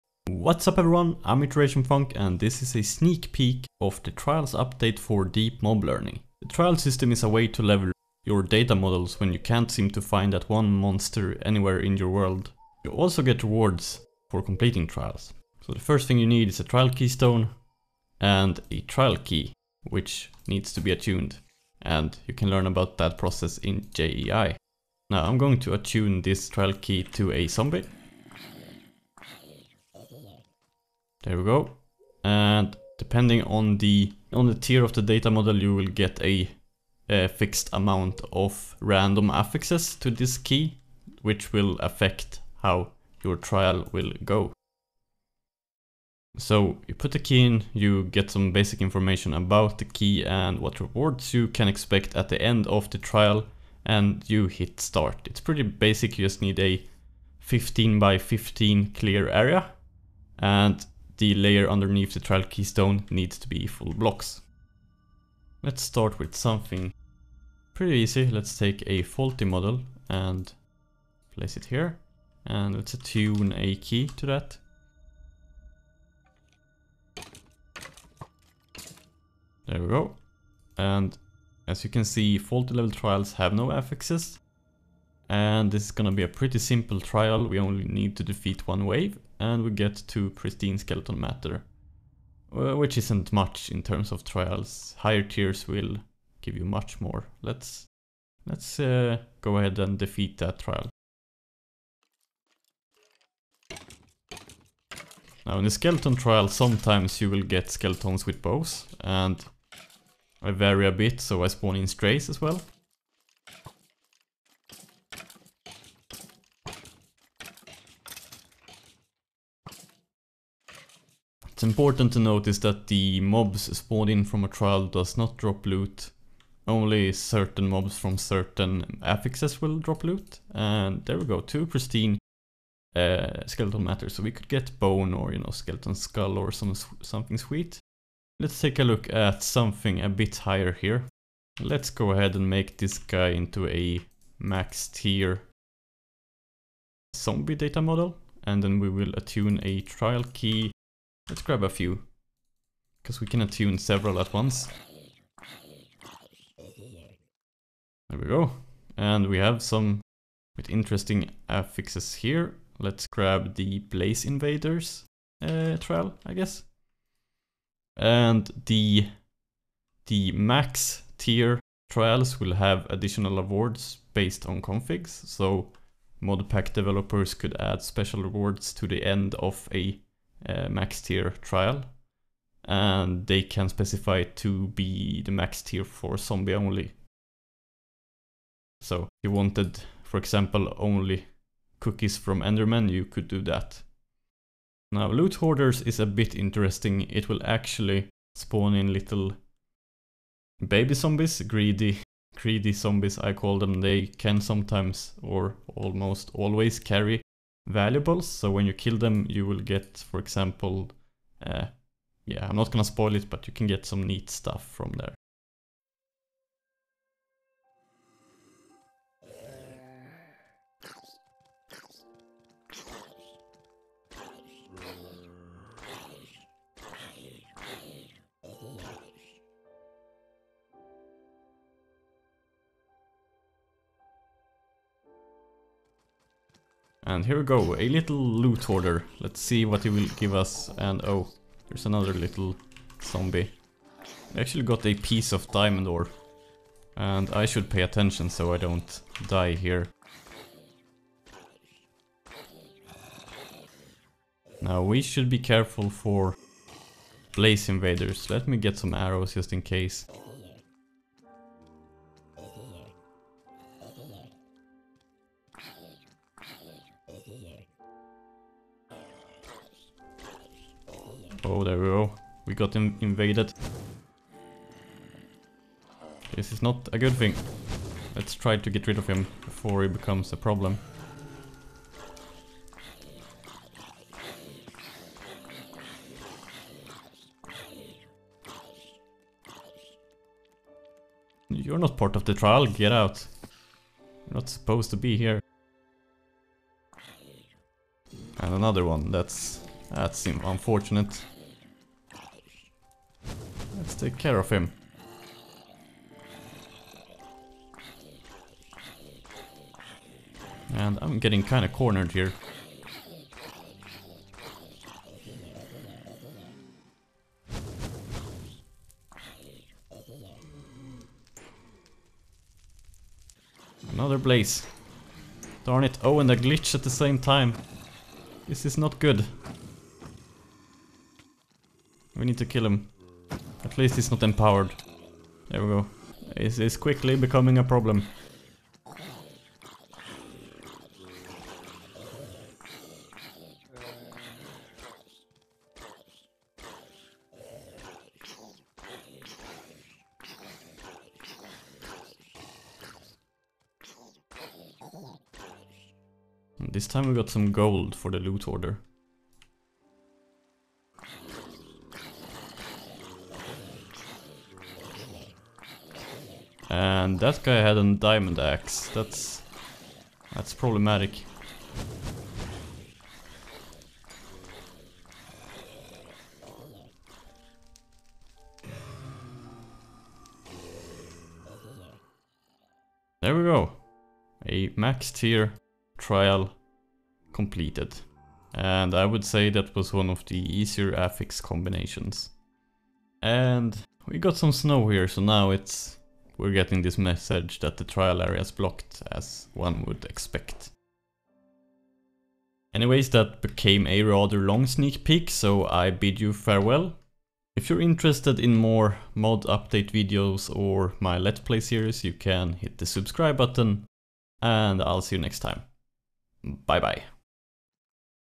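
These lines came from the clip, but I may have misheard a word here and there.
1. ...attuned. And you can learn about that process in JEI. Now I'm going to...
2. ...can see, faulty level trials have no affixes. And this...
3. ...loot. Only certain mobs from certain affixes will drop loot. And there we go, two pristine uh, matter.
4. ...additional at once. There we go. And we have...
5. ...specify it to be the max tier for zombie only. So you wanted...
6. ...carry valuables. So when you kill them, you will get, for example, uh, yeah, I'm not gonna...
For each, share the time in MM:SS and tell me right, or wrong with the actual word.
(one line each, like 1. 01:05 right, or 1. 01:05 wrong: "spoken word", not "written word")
1. 00:20 right
2. 01:21 right
3. 02:05 right
4. 02:33 wrong: "several", not "additional"
5. 03:03 right
6. 03:26 right.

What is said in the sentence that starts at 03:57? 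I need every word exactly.
And here we go, a little loot hoarder.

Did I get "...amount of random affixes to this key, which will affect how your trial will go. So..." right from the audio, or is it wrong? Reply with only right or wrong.
right.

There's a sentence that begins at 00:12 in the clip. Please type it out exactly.
You also get rewards for completing trials.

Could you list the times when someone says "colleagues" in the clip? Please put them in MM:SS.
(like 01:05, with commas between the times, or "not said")
not said.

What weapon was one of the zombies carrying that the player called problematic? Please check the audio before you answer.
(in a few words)
diamond axe.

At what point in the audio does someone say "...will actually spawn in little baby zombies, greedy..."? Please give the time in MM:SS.
03:17.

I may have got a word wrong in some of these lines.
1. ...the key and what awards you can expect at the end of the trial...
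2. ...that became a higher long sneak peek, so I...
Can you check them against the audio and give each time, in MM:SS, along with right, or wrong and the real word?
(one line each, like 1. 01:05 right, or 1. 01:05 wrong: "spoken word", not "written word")
1. 00:49 wrong: "rewards", not "awards"
2. 06:43 wrong: "rather", not "higher".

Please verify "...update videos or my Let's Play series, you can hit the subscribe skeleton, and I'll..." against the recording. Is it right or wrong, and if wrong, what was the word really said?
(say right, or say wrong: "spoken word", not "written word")
wrong: "button", not "skeleton".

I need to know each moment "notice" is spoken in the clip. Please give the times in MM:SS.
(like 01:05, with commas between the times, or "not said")
02:02.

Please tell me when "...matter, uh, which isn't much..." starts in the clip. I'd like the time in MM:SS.
01:31.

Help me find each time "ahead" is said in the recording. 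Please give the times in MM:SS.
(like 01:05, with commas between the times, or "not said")
01:39, 02:22.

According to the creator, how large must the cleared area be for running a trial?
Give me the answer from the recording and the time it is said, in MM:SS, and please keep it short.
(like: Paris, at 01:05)
15 by 15, at 00:57.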